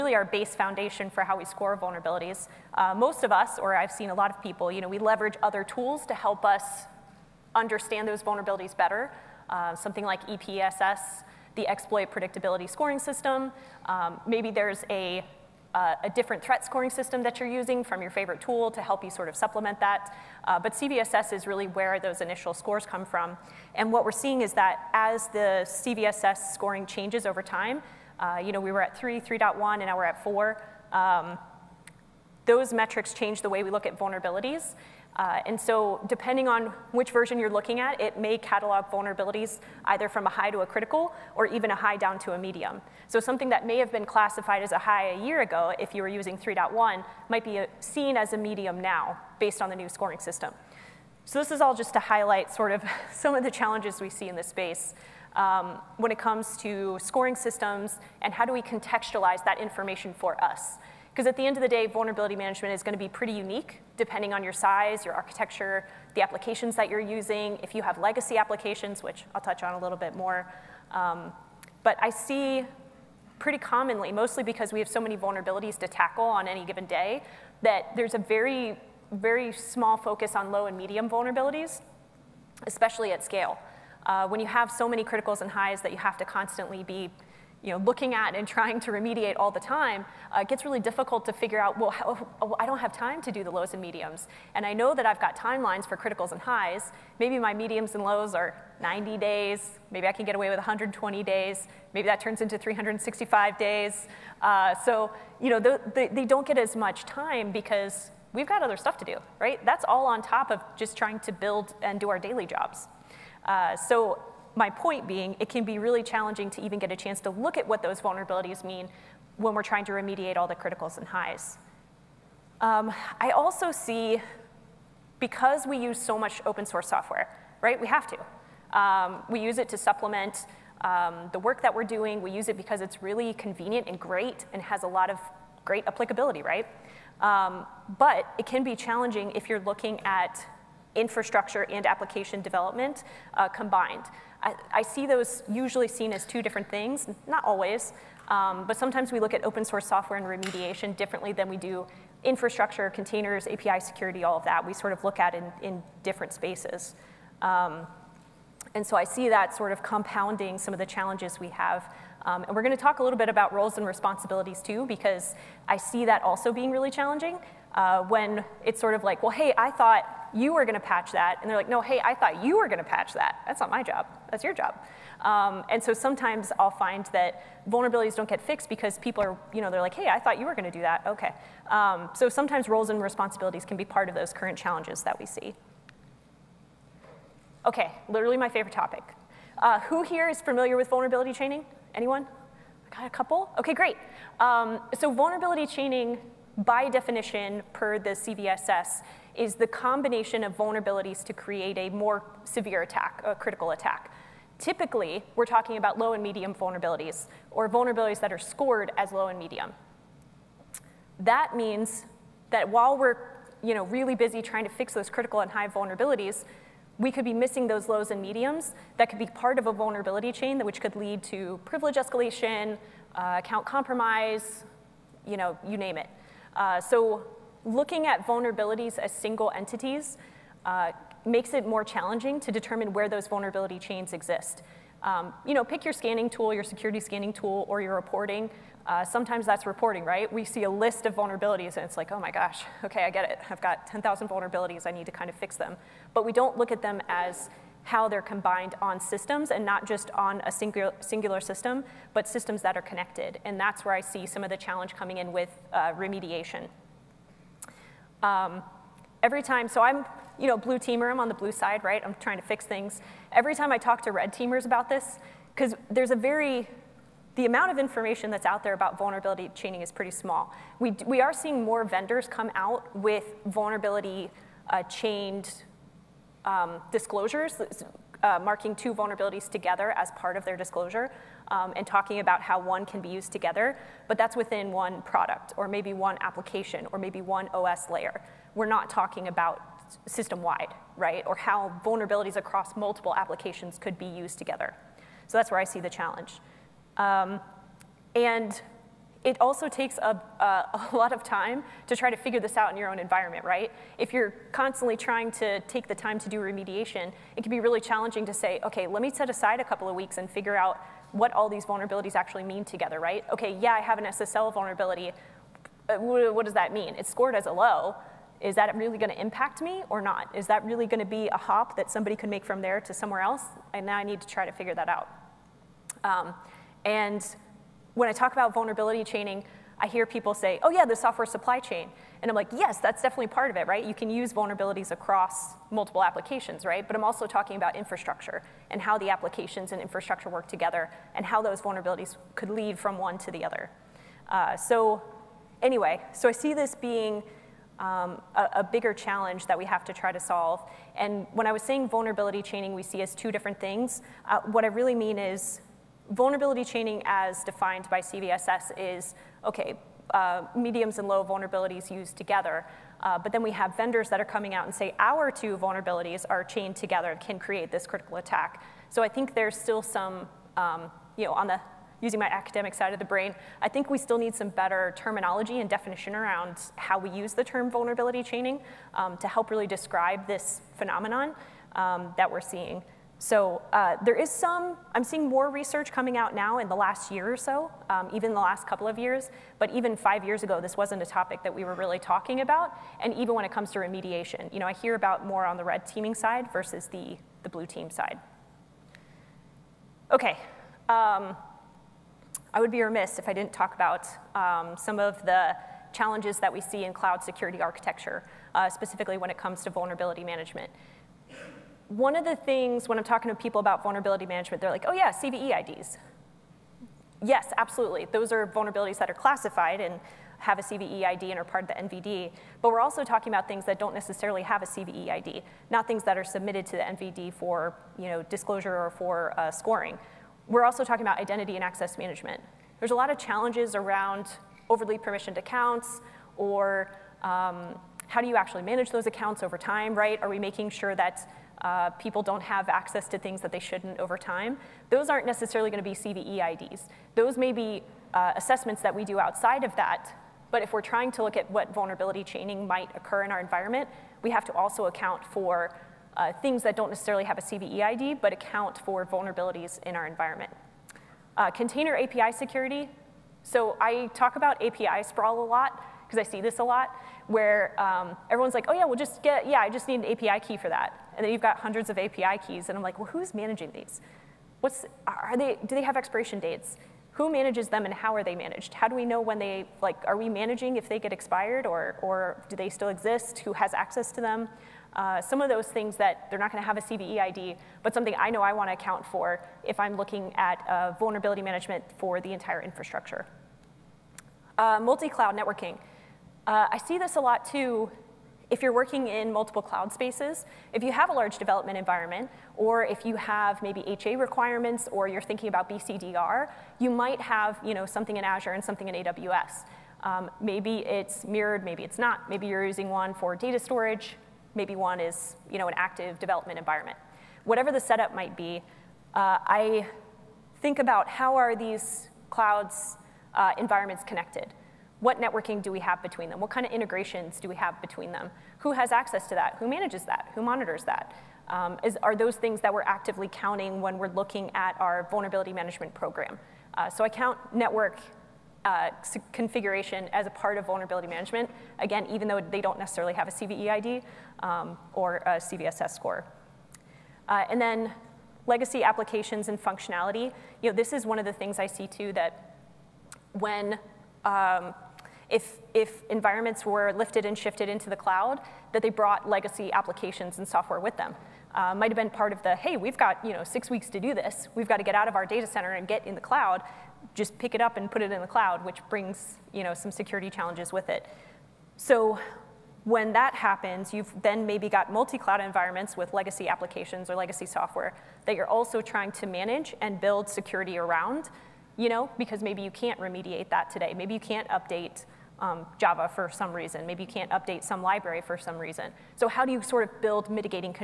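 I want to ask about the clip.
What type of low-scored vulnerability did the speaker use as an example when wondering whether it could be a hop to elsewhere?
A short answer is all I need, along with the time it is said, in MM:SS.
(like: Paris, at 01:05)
SSL vulnerability, at 05:14.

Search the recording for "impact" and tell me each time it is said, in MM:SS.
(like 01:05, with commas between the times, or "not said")
05:19.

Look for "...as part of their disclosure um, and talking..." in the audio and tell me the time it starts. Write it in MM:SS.
04:39.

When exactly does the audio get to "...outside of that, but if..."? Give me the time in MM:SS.
07:29.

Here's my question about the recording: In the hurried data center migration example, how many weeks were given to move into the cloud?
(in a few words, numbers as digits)
6.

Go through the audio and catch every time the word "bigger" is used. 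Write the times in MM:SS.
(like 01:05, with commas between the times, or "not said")
05:48.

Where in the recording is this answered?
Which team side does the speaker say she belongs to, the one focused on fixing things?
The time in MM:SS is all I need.
04:21.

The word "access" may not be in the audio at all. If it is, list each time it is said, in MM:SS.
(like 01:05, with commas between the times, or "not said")
07:11, 07:22, 08:03, 08:48.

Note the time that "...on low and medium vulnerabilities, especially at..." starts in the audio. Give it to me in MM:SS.
01:20.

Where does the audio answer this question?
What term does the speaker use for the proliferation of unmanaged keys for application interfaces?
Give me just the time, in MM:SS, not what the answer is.
07:44.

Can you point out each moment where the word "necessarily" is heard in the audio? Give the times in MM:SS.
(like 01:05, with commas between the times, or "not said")
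07:03, 07:25, 07:36, 09:02.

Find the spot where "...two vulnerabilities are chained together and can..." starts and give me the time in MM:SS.
06:05.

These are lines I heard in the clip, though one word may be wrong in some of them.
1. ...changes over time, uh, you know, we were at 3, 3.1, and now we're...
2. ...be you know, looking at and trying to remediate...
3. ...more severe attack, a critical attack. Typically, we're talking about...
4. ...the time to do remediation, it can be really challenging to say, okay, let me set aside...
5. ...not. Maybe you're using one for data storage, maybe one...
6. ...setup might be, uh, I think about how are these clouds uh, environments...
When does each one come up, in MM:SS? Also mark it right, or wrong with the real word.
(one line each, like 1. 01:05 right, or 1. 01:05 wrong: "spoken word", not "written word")
1. 00:26 right
2. 01:26 right
3. 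03:21 right
4. 05:05 right
5. 08:31 right
6. 08:37 right.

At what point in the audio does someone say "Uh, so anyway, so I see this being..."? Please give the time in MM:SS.
05:44.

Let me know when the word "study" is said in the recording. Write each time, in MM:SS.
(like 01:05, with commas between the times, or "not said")
not said.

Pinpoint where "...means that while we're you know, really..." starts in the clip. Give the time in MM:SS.
03:31.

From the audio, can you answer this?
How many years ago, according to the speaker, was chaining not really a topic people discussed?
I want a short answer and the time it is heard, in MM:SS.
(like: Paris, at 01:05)
5, at 06:29.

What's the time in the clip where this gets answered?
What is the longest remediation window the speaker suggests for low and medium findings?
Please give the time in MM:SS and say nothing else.
01:42.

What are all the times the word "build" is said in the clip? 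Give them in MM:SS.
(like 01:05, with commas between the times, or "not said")
01:51, 09:39, 09:50.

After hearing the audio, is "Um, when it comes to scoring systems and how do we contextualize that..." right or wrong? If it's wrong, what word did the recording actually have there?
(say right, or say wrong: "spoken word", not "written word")
right.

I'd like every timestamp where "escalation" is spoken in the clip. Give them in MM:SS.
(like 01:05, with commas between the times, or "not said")
03:41.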